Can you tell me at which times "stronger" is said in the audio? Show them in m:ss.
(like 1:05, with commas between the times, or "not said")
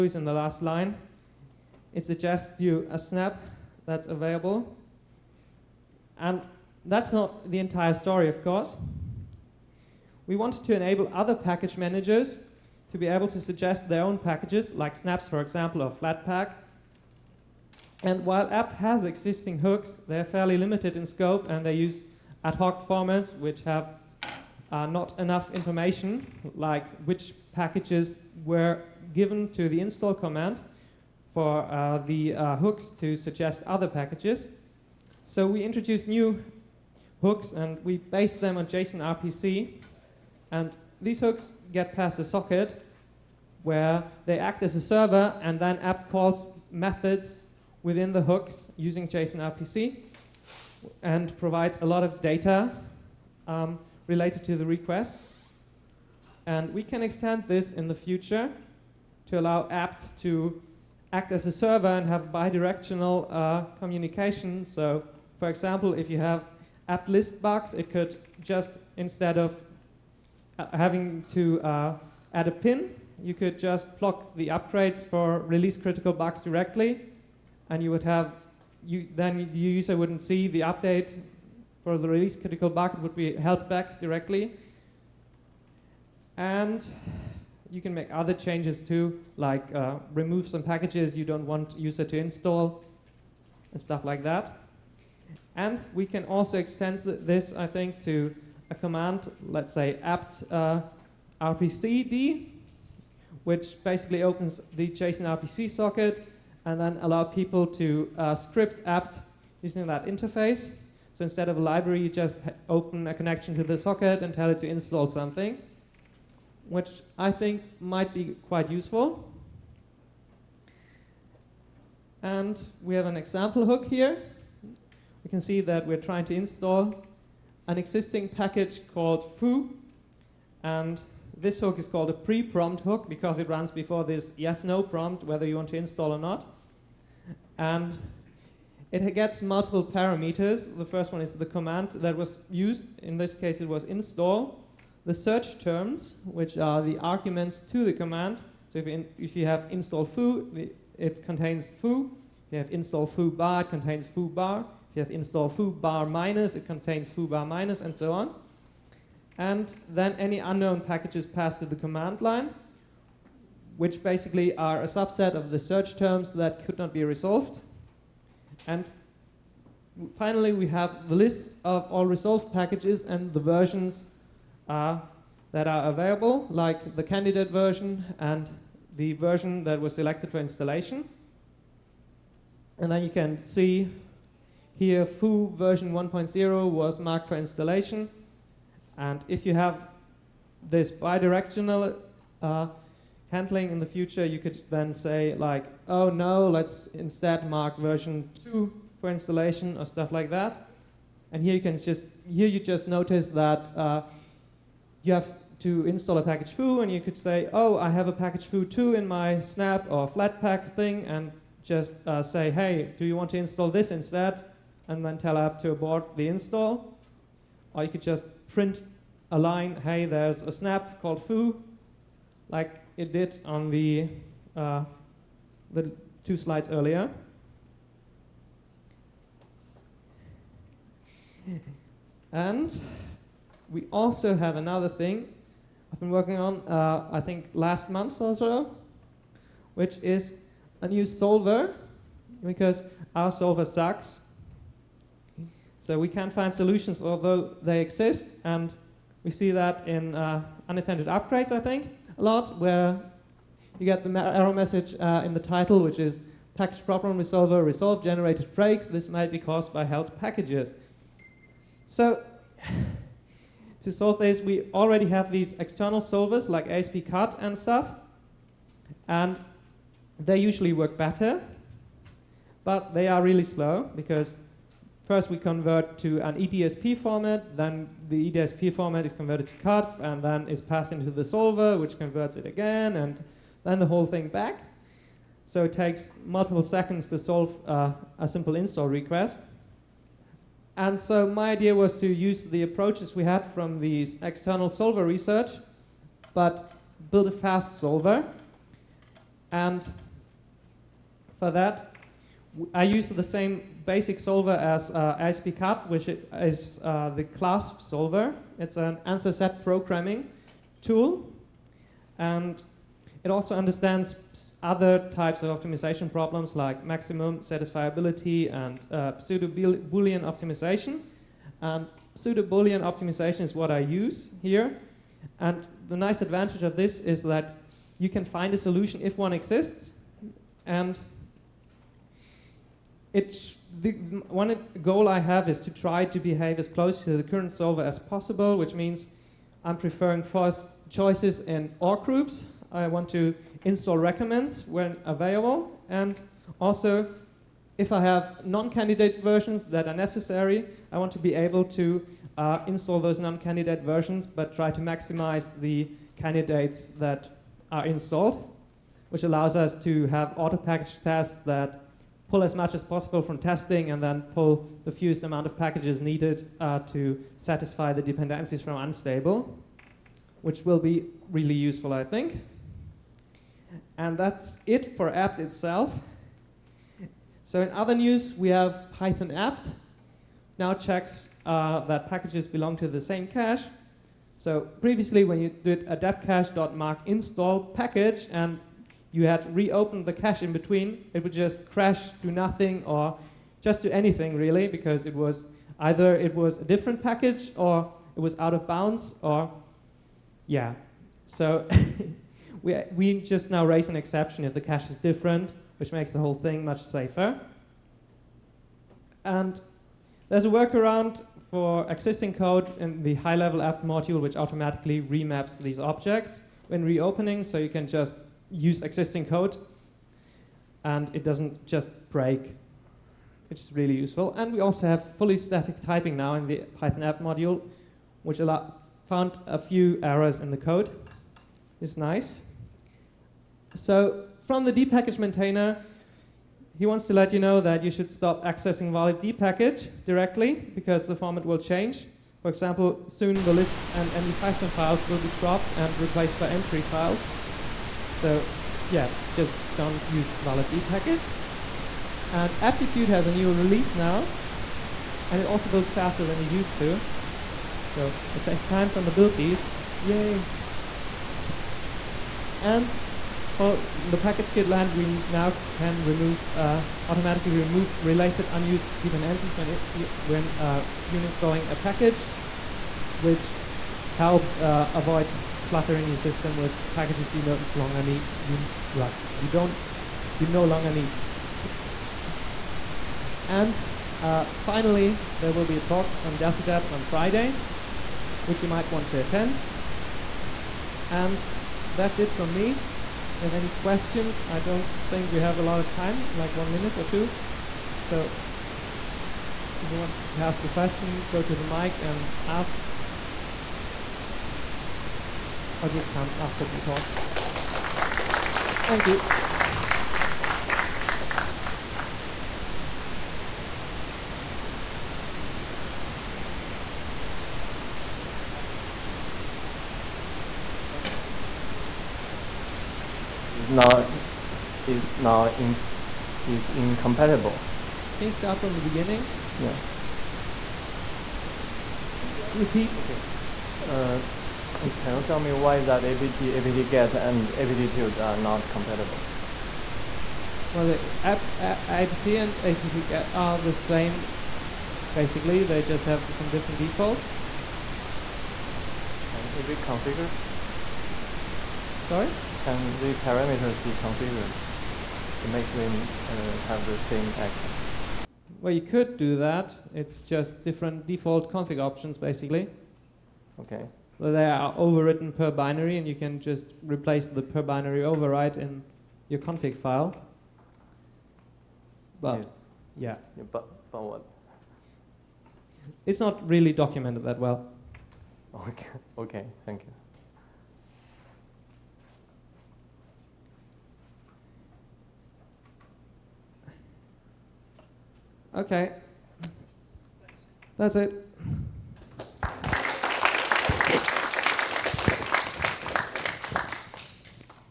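not said.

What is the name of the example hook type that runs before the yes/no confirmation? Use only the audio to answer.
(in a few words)
pre-prompt hook.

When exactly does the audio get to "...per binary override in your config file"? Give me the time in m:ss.
9:27.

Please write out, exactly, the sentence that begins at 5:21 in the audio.
And pseudo-Boolean optimization is what I use here.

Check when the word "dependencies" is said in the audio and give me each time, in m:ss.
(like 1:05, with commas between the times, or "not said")
6:08, 7:49.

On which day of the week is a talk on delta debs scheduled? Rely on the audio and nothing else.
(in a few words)
Friday.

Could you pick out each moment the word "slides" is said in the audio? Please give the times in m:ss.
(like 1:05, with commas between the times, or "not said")
3:46.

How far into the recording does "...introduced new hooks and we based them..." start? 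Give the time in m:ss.
0:35.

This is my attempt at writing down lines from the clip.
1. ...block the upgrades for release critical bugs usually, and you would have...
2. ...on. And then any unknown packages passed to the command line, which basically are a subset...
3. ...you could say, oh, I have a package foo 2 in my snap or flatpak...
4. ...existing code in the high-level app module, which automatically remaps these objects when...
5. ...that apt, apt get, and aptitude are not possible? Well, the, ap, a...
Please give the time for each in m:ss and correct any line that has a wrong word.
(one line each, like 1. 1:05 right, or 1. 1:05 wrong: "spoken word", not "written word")
1. 1:13 wrong: "directly", not "usually"
2. 2:38 right
3. 3:26 right
4. 6:51 right
5. 8:55 wrong: "compatible", not "possible".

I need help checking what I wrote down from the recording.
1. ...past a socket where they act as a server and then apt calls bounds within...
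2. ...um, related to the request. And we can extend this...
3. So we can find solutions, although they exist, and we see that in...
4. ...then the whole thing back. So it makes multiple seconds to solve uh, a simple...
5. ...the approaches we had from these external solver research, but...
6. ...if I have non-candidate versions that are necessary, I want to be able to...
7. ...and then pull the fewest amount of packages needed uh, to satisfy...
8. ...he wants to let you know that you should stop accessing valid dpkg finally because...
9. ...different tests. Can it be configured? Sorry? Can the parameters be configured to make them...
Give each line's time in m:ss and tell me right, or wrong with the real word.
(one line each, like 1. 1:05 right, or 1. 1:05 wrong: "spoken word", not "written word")
1. 0:41 wrong: "methods", not "bounds"
2. 0:53 right
3. 4:05 right
4. 4:43 wrong: "takes", not "makes"
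5. 4:52 right
6. 5:47 right
7. 6:03 right
8. 7:16 wrong: "directly", not "finally"
9. 9:06 wrong: "defaults", not "tests".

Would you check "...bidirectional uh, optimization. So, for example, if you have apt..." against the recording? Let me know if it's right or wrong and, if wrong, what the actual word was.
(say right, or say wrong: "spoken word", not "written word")
wrong: "communication", not "optimization".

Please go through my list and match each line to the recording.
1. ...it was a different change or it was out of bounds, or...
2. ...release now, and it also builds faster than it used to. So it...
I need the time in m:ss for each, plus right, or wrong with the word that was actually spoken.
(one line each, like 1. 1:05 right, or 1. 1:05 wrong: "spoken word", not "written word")
1. 6:36 wrong: "package", not "change"
2. 7:33 right.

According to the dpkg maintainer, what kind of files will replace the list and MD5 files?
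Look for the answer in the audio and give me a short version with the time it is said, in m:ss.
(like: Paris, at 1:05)
M3 files, at 7:26.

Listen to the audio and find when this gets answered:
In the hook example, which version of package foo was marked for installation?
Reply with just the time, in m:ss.
3:05.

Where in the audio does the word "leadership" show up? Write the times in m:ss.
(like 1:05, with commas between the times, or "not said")
not said.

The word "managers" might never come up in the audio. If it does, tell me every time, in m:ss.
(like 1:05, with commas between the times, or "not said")
0:11.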